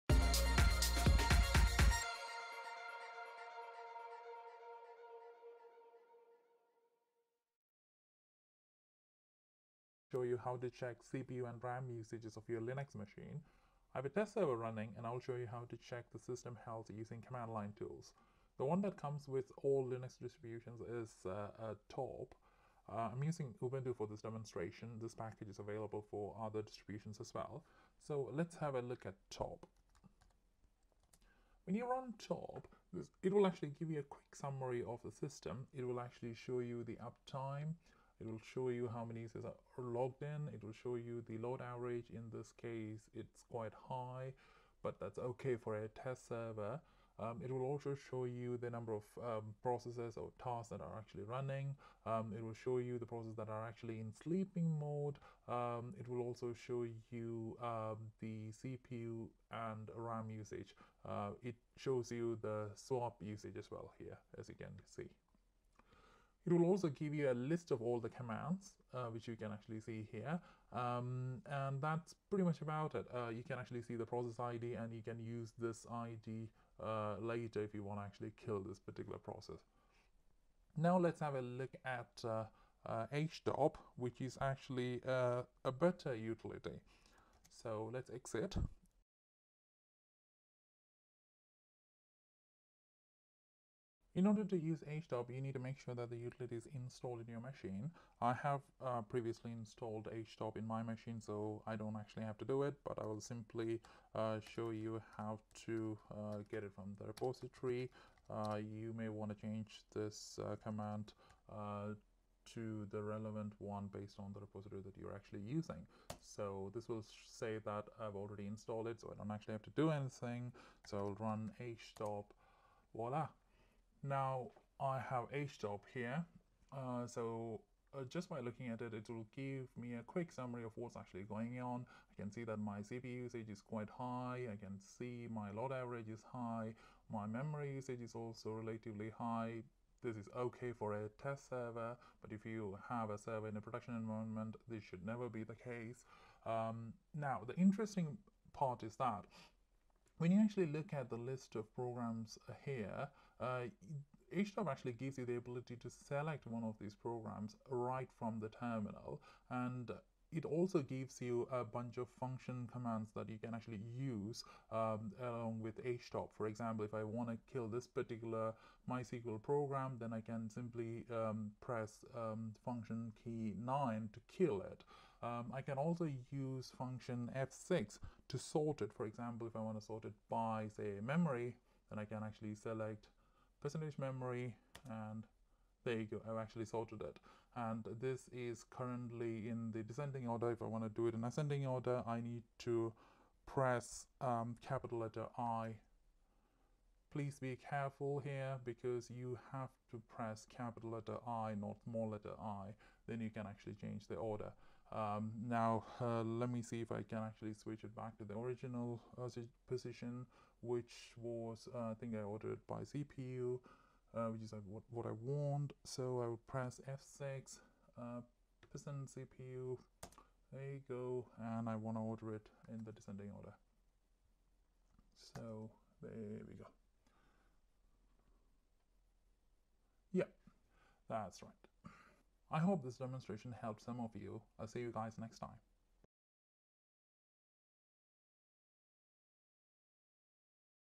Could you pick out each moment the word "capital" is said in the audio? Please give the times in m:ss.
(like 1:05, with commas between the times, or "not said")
3:14, 3:20.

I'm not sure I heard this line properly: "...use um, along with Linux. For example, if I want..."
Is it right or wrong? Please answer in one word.
wrong.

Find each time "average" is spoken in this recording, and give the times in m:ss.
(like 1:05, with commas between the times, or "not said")
0:41, 2:15.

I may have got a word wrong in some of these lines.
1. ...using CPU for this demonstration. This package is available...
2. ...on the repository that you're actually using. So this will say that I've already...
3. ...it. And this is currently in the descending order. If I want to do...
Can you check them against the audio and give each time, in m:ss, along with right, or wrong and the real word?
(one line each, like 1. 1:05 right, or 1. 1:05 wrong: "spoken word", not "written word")
1. 0:23 wrong: "Ubuntu", not "CPU"
2. 1:54 right
3. 3:07 right.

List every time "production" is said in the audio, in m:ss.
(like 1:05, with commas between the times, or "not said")
2:23.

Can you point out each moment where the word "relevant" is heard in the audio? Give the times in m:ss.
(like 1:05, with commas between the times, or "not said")
1:53.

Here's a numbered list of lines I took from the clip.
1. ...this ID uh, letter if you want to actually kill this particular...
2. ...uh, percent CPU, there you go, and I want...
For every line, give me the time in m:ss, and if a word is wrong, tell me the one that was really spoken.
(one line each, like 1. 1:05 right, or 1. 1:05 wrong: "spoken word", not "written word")
1. 1:15 wrong: "later", not "letter"
2. 3:37 right.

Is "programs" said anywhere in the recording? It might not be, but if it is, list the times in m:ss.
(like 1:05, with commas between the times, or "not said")
2:31, 2:36, 2:49.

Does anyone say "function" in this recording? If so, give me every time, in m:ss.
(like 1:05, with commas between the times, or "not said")
2:42, 2:52, 2:56.